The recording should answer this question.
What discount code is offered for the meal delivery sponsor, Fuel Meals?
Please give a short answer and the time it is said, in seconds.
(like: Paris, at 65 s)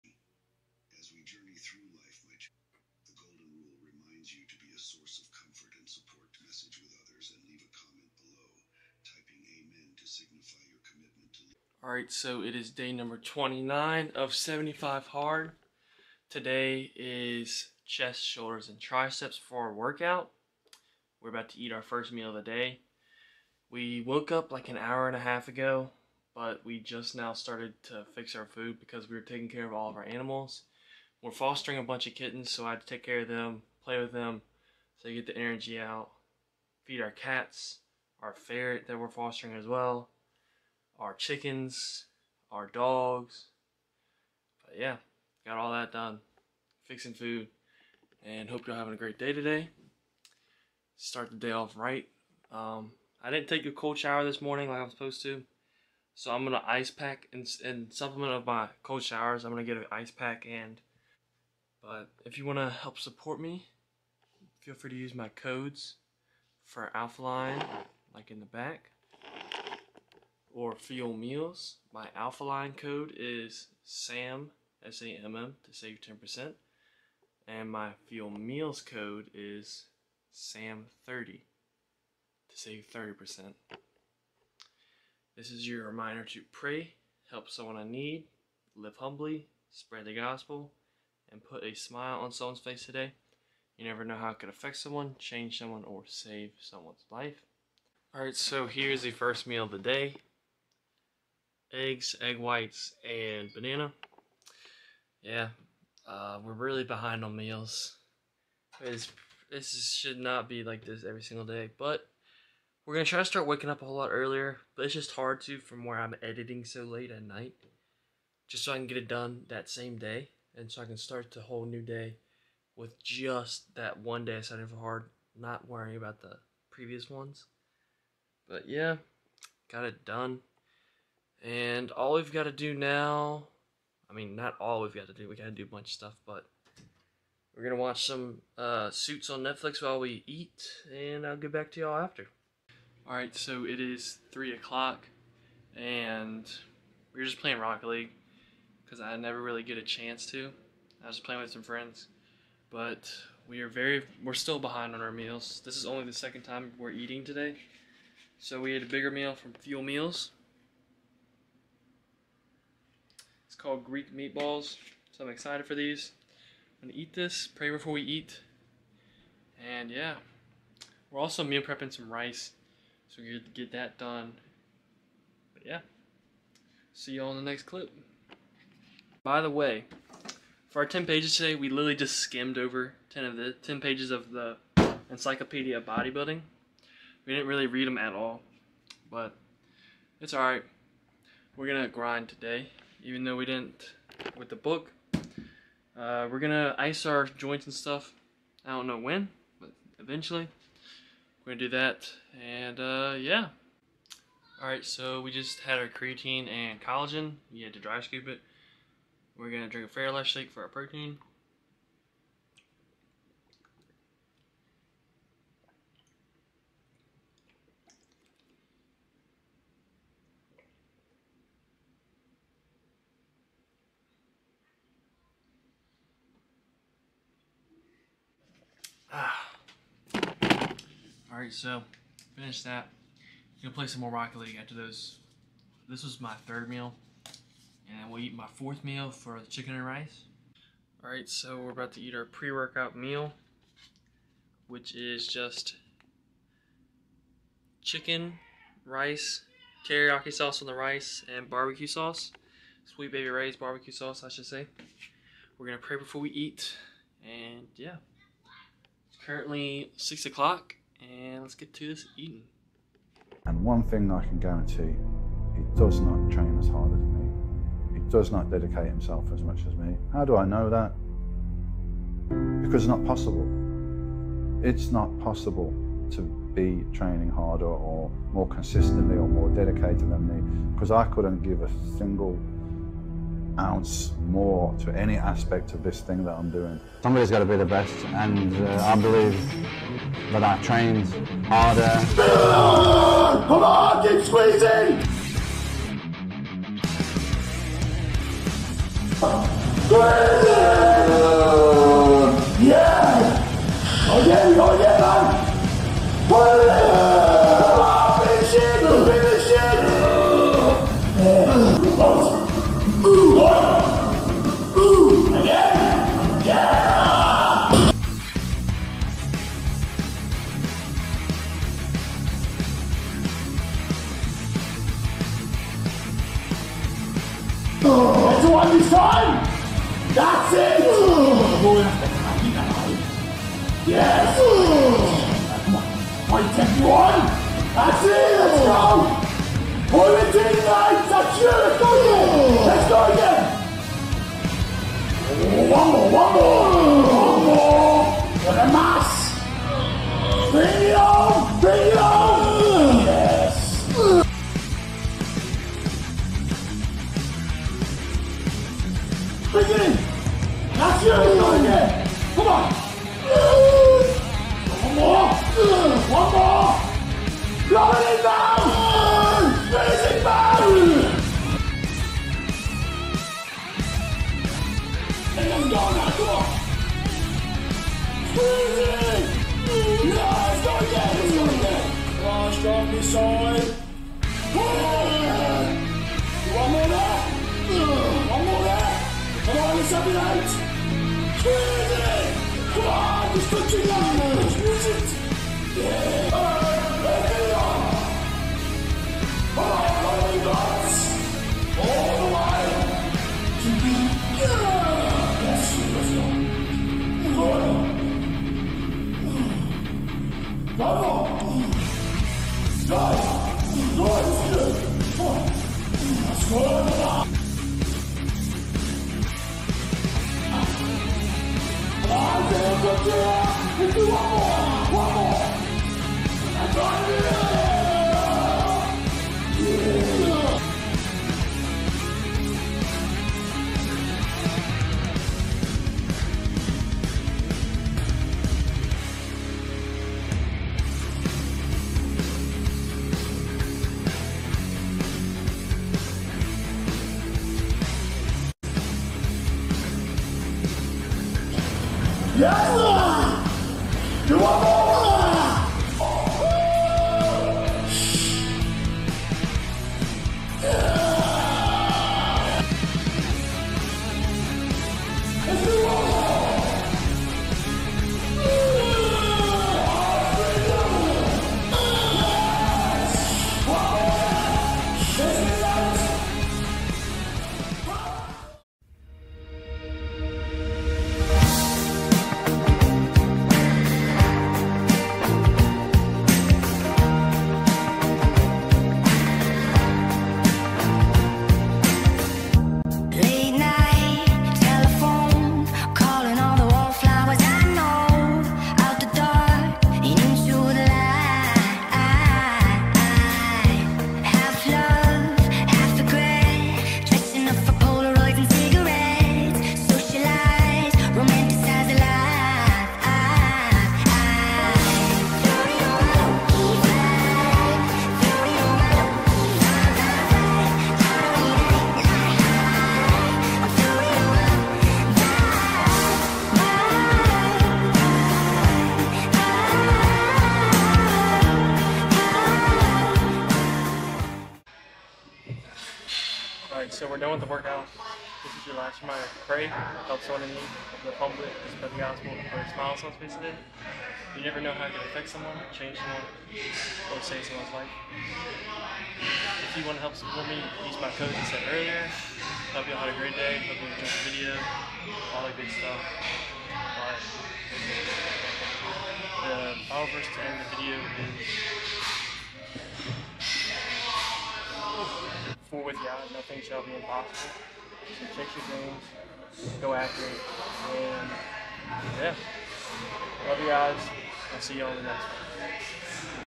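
SAM30, at 80 s.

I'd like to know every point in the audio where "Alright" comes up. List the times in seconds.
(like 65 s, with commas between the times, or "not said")
98 s, 143 s, 231 s.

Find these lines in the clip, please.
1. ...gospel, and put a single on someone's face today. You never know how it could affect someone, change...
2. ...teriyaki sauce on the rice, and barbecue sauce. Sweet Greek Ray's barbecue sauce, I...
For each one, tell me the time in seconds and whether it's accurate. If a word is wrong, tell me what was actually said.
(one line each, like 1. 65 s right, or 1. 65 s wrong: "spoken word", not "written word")
1. 90 s wrong: "smile", not "single"
2. 249 s wrong: "Baby", not "Greek".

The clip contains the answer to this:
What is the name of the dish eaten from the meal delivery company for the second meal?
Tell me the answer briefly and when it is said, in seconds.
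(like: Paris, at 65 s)
Greek meatballs, at 163 s.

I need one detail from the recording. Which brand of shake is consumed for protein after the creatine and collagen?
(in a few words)
Fairlife.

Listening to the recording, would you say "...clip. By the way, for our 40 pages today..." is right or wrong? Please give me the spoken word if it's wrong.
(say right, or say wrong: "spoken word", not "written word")
wrong: "10", not "40".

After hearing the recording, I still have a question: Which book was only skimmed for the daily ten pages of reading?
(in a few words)
Encyclopedia of Bodybuilding.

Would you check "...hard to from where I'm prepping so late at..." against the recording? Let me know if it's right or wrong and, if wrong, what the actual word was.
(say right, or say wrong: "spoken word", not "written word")
wrong: "editing", not "prepping".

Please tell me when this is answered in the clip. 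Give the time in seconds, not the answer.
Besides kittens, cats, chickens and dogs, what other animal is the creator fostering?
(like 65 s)
38 s.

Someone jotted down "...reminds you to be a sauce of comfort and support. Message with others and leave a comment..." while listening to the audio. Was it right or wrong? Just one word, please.
wrong.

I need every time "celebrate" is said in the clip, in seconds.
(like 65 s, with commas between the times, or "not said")
not said.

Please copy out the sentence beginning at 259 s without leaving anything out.
It's currently six o'clock, and let's get to this eating.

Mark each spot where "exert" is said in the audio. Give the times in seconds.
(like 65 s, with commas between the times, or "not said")
not said.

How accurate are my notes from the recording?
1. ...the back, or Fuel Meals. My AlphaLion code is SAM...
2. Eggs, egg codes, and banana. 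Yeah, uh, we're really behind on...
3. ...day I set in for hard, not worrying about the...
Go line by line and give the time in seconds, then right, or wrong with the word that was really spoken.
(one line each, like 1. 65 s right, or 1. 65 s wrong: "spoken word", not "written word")
1. 68 s right
2. 101 s wrong: "whites", not "codes"
3. 124 s right.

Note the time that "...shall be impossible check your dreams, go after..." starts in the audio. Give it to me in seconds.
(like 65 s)
566 s.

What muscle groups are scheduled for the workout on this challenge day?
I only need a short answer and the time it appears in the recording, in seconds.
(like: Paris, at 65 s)
Chest, shoulders, and triceps, at 17 s.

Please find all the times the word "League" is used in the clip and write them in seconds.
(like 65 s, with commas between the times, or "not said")
147 s, 234 s.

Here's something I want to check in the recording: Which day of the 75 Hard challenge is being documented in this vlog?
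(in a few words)
29.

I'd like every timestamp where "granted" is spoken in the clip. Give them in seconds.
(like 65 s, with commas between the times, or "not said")
not said.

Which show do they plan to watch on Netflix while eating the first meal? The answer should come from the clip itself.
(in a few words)
Suits.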